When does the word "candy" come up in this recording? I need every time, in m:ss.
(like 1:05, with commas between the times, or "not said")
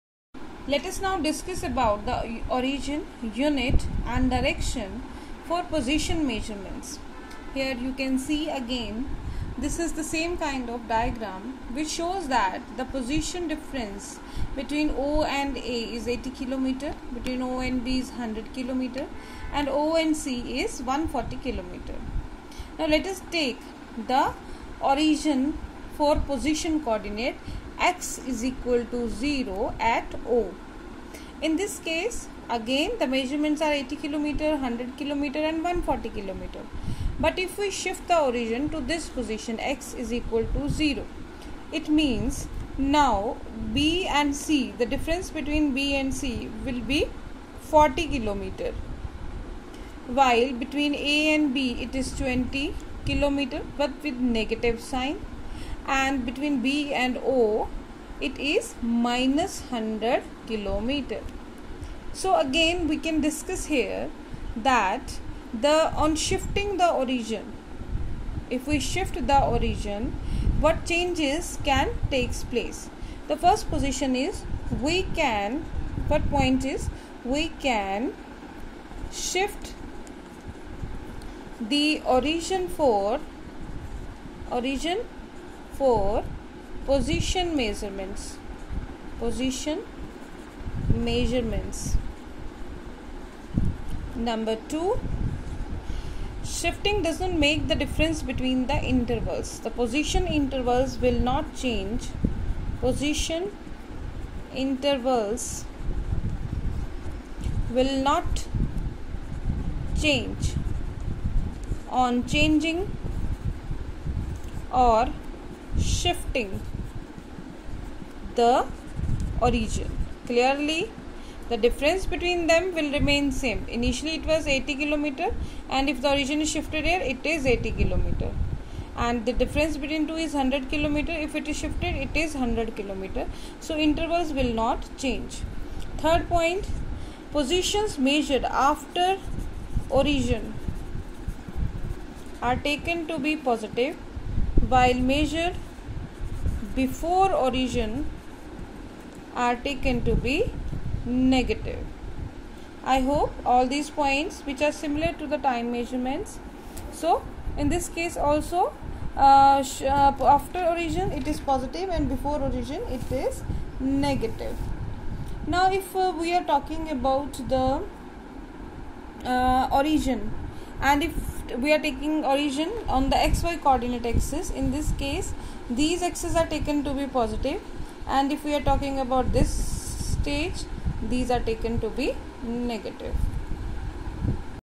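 not said.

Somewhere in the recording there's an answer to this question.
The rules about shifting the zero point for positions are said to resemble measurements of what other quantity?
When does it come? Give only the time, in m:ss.
2:35.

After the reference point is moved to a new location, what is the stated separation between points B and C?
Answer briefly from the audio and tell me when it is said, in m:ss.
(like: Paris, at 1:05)
40 km, at 0:47.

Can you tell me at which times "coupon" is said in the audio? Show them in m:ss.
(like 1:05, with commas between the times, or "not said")
not said.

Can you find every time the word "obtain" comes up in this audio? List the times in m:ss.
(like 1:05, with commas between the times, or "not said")
not said.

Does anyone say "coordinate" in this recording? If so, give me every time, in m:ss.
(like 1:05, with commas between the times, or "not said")
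0:26, 2:53.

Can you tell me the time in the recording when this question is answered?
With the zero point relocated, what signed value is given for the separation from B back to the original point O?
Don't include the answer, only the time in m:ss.
0:58.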